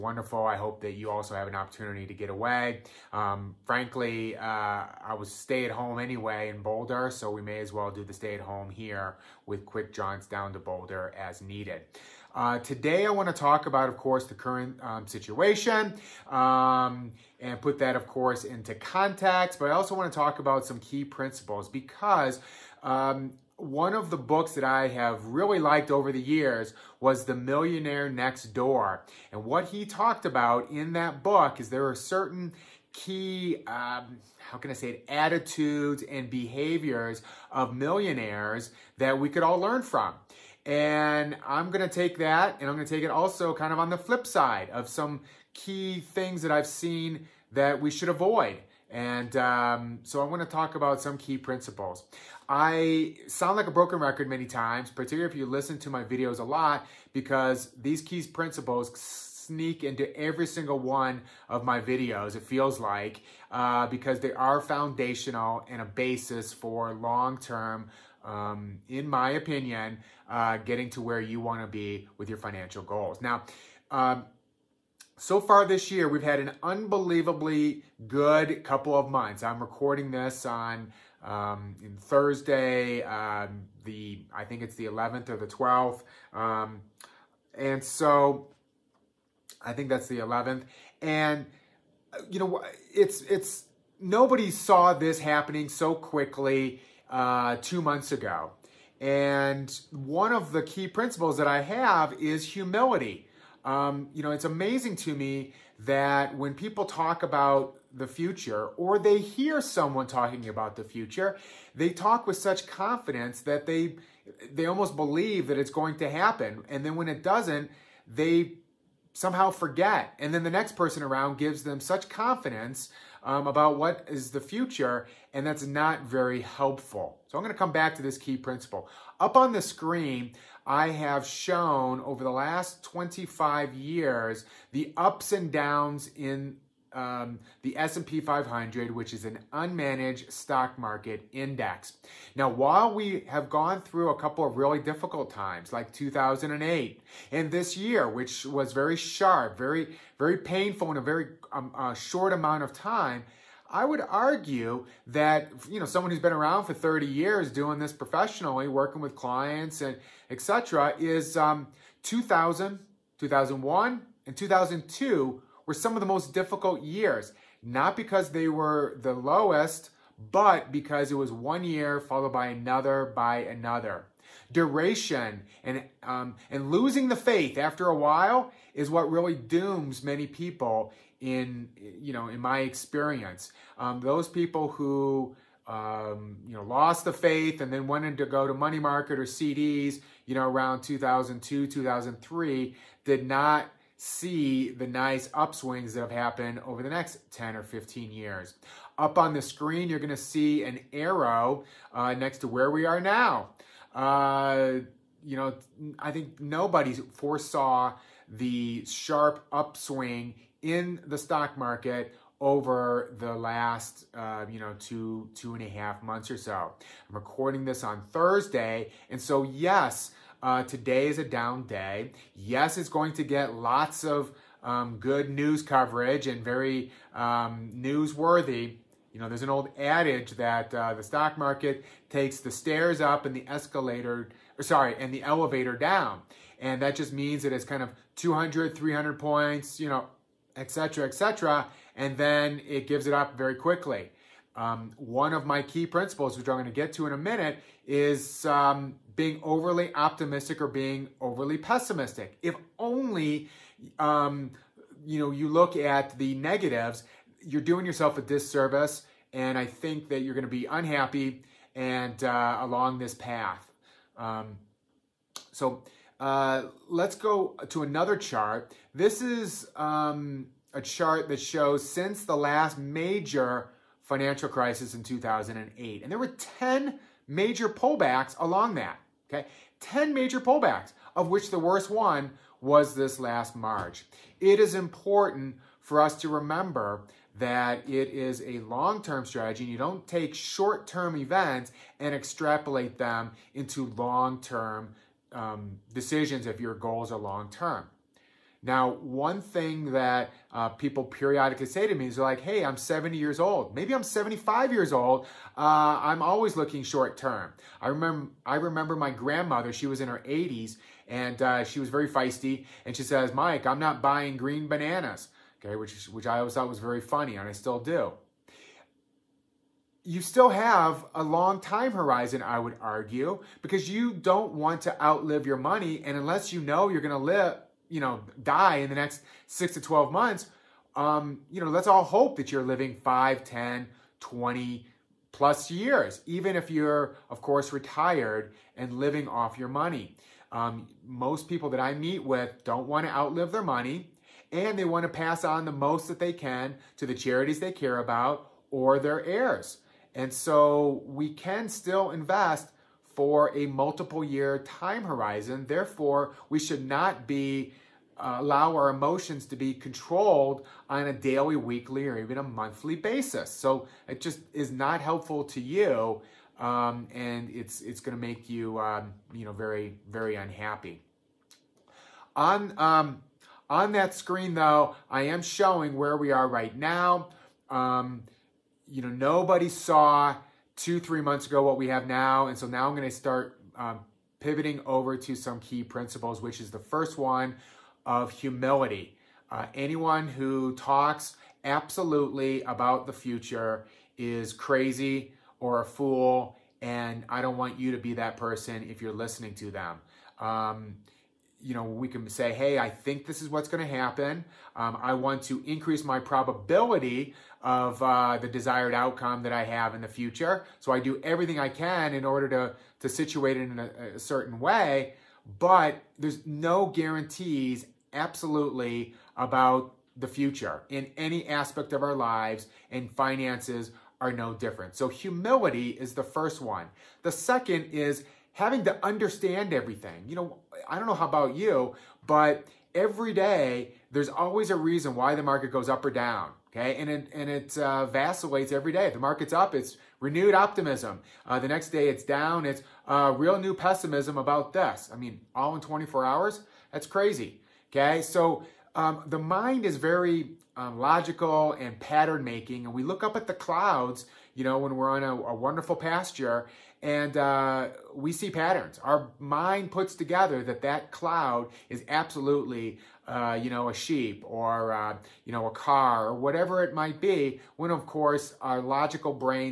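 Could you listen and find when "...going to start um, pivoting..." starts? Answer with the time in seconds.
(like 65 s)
382 s.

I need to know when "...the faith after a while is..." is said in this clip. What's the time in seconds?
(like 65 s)
177 s.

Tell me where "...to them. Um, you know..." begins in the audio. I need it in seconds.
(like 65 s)
399 s.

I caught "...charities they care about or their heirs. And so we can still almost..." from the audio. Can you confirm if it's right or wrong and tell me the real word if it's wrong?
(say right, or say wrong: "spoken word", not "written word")
wrong: "invest", not "almost".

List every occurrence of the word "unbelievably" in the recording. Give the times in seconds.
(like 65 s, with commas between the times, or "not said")
76 s.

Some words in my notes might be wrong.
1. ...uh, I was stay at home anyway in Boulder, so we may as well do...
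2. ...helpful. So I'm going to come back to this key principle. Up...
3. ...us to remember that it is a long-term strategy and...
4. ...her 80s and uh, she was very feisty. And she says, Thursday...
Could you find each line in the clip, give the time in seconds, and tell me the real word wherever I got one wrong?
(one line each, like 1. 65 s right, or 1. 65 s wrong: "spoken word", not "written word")
1. 4 s right
2. 126 s right
3. 286 s right
4. 310 s wrong: "Mike", not "Thursday".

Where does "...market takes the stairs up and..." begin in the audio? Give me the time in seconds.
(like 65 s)
231 s.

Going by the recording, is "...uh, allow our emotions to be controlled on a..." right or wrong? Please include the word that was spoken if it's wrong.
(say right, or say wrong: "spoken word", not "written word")
right.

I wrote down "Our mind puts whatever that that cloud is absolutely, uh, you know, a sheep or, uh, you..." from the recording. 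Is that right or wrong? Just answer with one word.
wrong.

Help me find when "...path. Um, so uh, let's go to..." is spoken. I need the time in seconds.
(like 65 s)
263 s.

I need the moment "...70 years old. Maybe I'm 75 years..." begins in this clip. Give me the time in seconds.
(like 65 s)
302 s.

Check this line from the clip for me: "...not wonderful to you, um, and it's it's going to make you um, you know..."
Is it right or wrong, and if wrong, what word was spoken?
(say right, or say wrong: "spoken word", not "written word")
wrong: "helpful", not "wonderful".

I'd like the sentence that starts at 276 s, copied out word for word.
And there were 10 major pullbacks along that, okay?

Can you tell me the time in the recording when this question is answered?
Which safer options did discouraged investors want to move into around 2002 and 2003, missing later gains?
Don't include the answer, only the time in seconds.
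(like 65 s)
188 s.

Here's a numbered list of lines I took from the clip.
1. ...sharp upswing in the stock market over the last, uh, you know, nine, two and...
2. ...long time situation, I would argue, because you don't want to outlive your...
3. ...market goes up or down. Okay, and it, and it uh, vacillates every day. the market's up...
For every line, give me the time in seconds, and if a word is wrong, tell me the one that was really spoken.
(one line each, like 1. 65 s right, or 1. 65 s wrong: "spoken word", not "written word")
1. 208 s wrong: "two", not "nine"
2. 321 s wrong: "horizon", not "situation"
3. 435 s right.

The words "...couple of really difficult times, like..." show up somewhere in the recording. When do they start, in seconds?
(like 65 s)
144 s.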